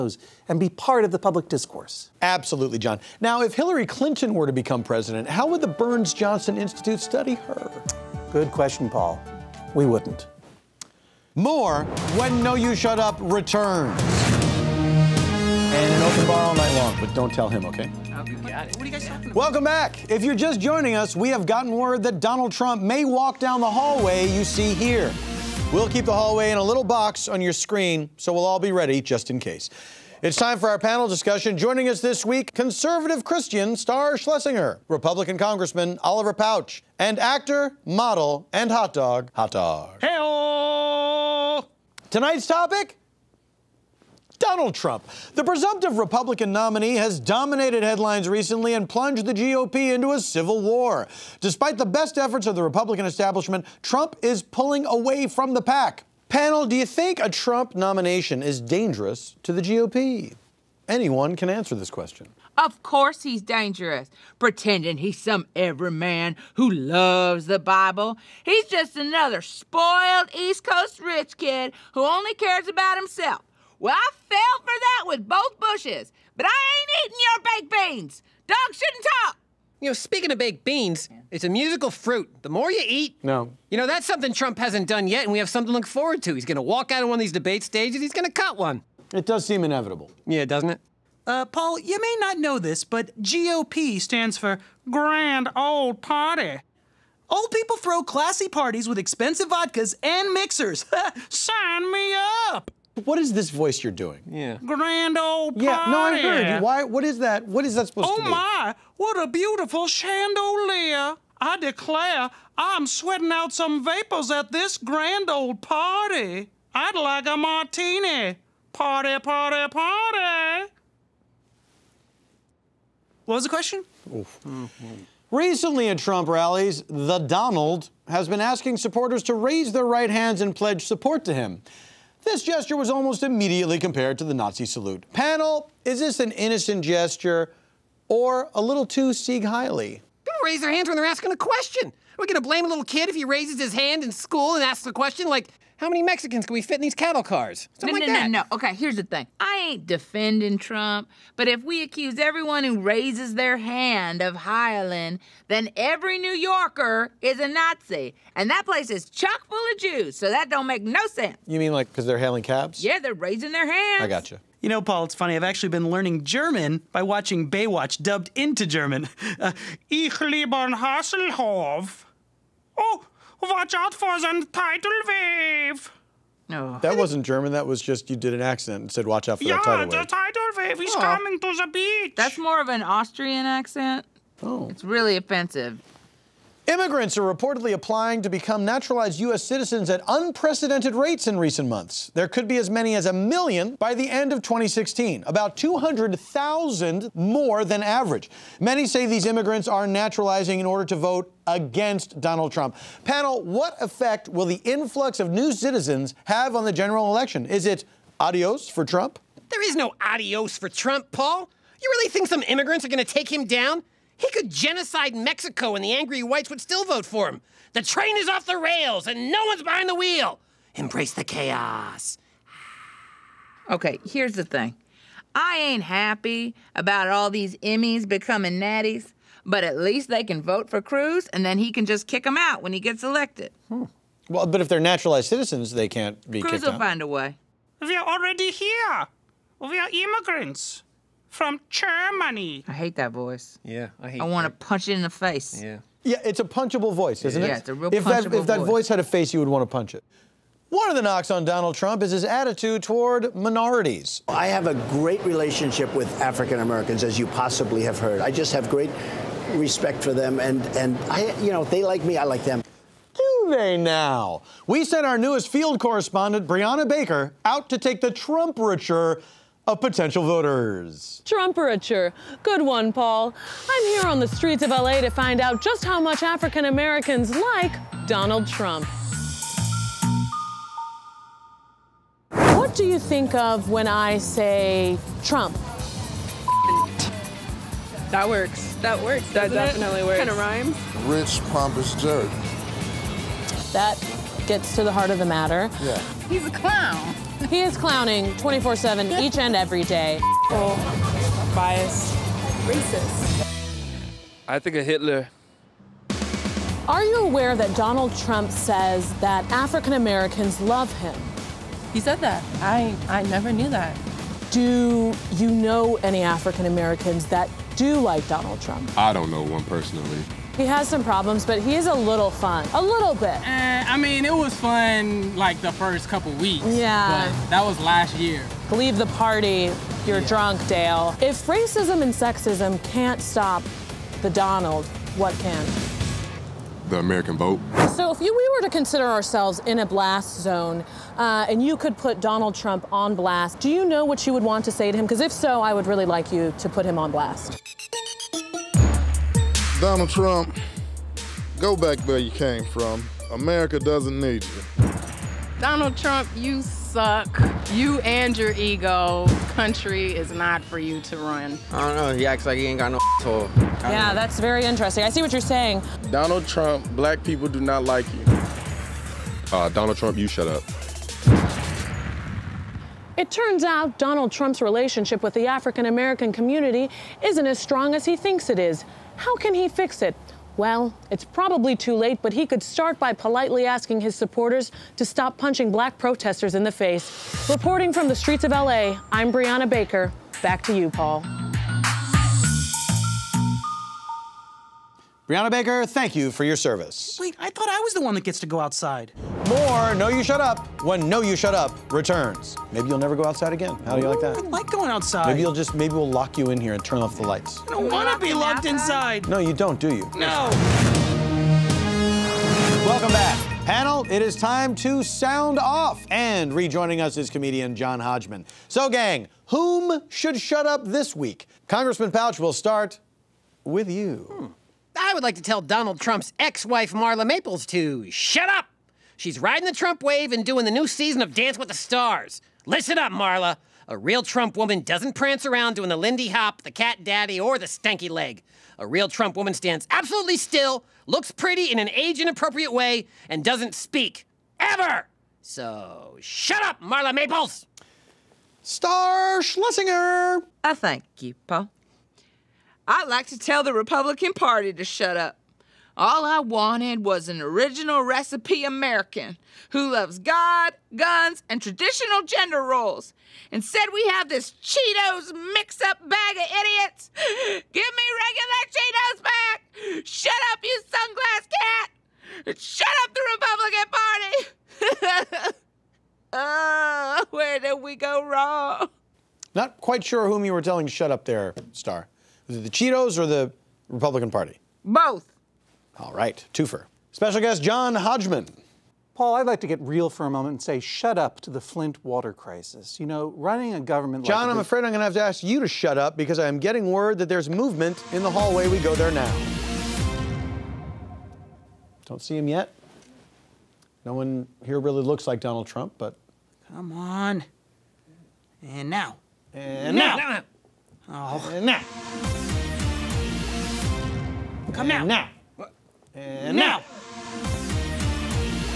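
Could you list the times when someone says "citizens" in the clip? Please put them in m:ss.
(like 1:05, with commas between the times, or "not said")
3:09, 3:25, 3:55.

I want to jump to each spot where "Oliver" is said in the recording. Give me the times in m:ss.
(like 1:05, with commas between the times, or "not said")
0:36.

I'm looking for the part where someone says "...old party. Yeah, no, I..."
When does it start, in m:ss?
1:45.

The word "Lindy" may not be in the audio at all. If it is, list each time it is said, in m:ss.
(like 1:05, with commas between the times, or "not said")
7:15.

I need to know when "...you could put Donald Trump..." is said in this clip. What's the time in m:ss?
5:41.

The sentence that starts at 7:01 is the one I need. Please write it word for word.
Congressman Pouch will start with you.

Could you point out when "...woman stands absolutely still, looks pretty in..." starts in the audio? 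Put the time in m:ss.
7:19.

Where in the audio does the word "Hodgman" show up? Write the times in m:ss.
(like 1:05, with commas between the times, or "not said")
6:57, 8:07.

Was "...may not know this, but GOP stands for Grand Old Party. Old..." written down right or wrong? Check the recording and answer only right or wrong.
right.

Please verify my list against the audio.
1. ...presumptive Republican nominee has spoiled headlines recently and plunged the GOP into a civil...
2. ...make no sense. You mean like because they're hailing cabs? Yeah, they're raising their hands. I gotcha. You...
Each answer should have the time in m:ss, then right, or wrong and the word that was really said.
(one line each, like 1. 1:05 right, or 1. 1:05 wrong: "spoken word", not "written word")
1. 0:45 wrong: "dominated", not "spoiled"
2. 2:40 right.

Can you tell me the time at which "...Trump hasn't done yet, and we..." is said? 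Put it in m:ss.
1:24.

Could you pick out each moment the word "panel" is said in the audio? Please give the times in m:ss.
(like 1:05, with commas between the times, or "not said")
0:30, 0:56, 2:15, 3:23, 6:53.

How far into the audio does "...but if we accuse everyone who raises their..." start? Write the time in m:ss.
2:31.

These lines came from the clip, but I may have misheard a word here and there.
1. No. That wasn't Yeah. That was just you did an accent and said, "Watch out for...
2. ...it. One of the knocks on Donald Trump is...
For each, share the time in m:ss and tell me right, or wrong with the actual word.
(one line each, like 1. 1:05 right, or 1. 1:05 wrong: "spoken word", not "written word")
1. 2:56 wrong: "German", not "Yeah"
2. 4:09 right.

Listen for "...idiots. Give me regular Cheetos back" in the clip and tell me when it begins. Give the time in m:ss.
7:46.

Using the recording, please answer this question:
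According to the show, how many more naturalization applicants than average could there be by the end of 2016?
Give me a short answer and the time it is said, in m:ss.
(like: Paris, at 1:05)
200,000, at 3:15.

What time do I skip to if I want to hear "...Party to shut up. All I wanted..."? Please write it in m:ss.
7:34.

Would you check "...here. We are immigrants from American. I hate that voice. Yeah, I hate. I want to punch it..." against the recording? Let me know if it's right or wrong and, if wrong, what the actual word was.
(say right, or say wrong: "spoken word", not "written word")
wrong: "Germany", not "American".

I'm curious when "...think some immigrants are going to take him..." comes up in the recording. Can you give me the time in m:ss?
3:32.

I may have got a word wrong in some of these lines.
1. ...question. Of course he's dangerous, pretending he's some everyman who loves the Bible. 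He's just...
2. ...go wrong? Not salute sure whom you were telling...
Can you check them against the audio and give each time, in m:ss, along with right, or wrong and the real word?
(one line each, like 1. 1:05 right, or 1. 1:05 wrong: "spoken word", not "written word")
1. 1:01 right
2. 7:57 wrong: "quite", not "salute".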